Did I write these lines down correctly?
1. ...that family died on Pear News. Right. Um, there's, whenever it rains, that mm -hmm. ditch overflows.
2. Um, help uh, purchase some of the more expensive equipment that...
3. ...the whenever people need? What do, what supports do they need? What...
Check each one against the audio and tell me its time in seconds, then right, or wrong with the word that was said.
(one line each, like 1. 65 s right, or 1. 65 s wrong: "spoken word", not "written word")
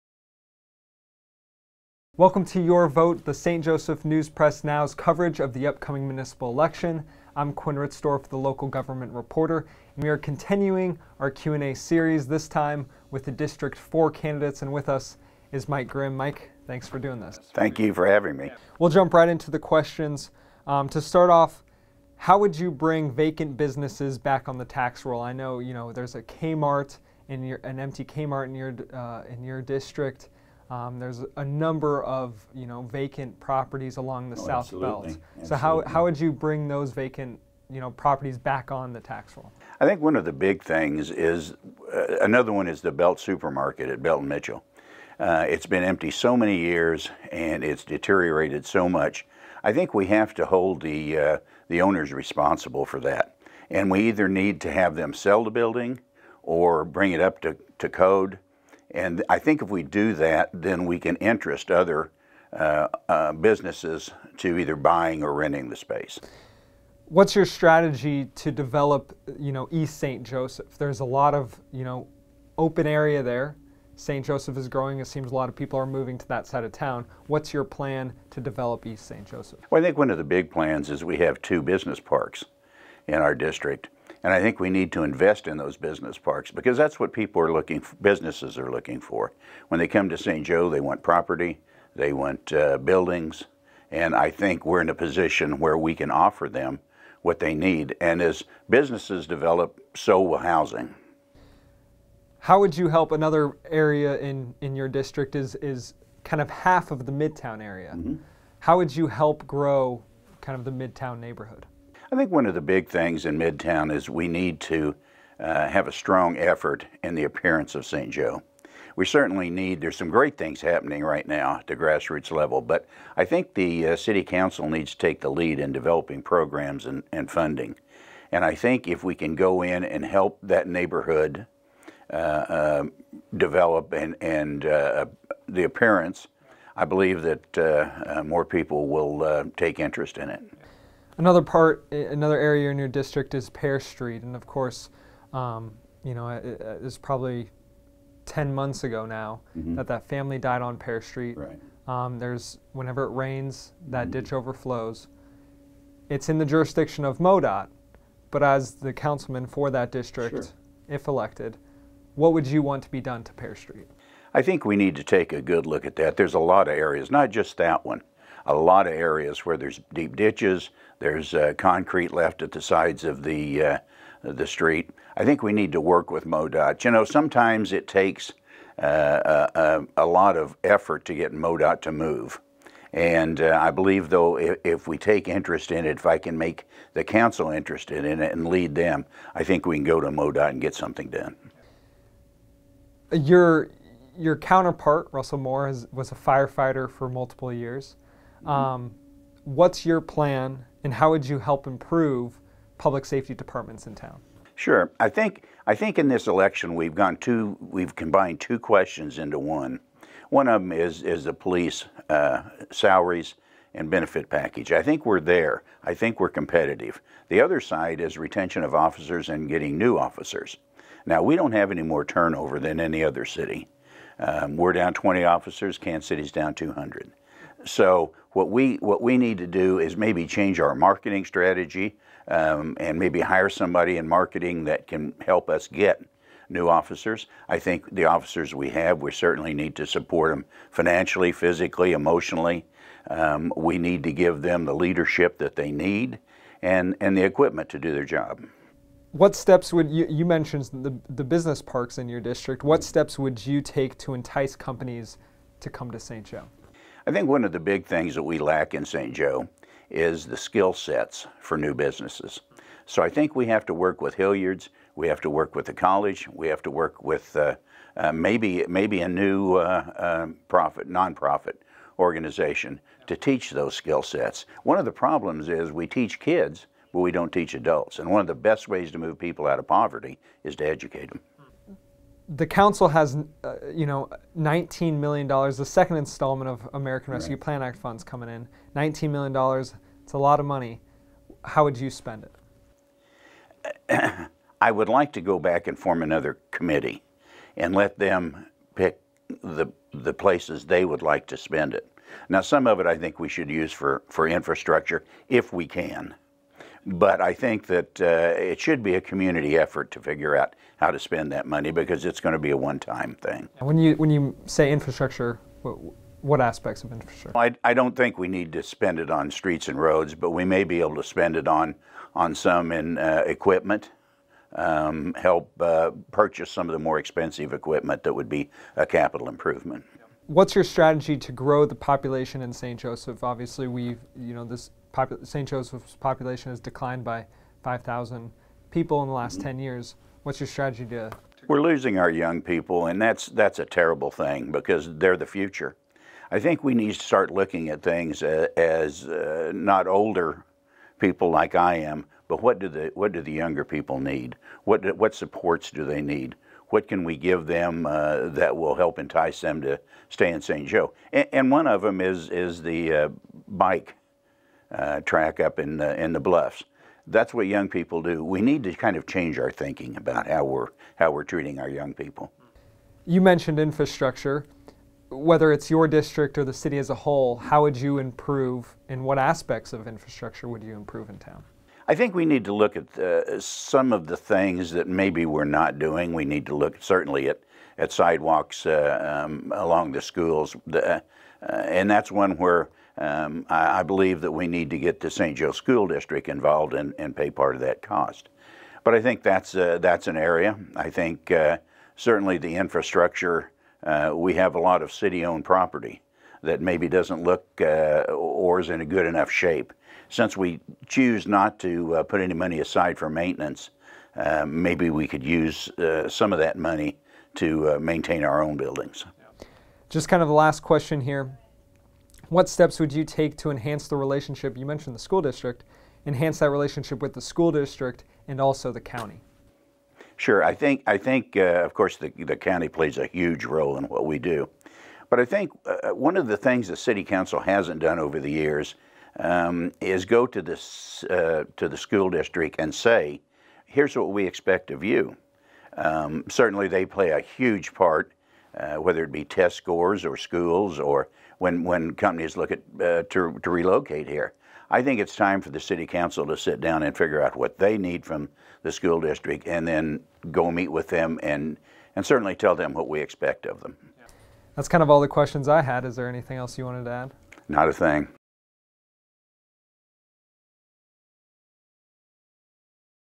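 1. 149 s wrong: "Street", not "News"
2. 324 s right
3. 353 s wrong: "younger", not "whenever".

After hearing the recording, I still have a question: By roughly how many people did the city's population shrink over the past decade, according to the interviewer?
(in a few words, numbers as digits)
5,000.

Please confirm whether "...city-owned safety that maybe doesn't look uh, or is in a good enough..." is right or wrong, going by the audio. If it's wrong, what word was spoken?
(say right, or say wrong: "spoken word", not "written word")
wrong: "property", not "safety".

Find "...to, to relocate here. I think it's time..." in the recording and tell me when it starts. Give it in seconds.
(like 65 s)
453 s.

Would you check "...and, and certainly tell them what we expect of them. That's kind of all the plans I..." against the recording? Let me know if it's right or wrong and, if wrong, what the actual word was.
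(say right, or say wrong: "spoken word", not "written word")
wrong: "questions", not "plans".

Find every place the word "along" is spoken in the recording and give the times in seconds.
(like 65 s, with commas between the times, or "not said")
33 s, 389 s.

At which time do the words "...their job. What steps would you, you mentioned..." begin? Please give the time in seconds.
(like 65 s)
247 s.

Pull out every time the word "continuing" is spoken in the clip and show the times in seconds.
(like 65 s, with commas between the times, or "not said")
10 s.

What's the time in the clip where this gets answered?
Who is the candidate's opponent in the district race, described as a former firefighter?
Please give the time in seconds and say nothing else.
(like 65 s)
195 s.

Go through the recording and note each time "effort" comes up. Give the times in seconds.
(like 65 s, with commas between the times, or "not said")
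116 s, 180 s, 309 s.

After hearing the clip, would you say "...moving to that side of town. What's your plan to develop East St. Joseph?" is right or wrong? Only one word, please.
right.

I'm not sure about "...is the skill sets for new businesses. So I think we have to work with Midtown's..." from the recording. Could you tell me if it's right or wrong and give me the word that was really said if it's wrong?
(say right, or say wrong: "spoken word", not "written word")
wrong: "Hillyard", not "Midtown".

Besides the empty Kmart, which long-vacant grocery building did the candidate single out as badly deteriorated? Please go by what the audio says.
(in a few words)
Belt Supermarket.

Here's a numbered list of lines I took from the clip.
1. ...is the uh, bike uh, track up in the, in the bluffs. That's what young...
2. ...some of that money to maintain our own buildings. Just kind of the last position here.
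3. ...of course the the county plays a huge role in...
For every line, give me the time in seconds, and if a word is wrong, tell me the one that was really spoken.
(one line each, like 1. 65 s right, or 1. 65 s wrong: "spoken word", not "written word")
1. 362 s right
2. 416 s wrong: "question", not "position"
3. 431 s right.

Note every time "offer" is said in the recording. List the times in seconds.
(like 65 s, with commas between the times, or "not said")
96 s.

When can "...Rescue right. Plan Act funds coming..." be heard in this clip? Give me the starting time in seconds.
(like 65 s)
287 s.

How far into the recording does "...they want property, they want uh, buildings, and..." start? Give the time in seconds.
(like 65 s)
90 s.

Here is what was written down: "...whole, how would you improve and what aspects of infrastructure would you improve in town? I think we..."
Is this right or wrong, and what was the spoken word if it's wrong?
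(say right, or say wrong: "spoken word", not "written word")
right.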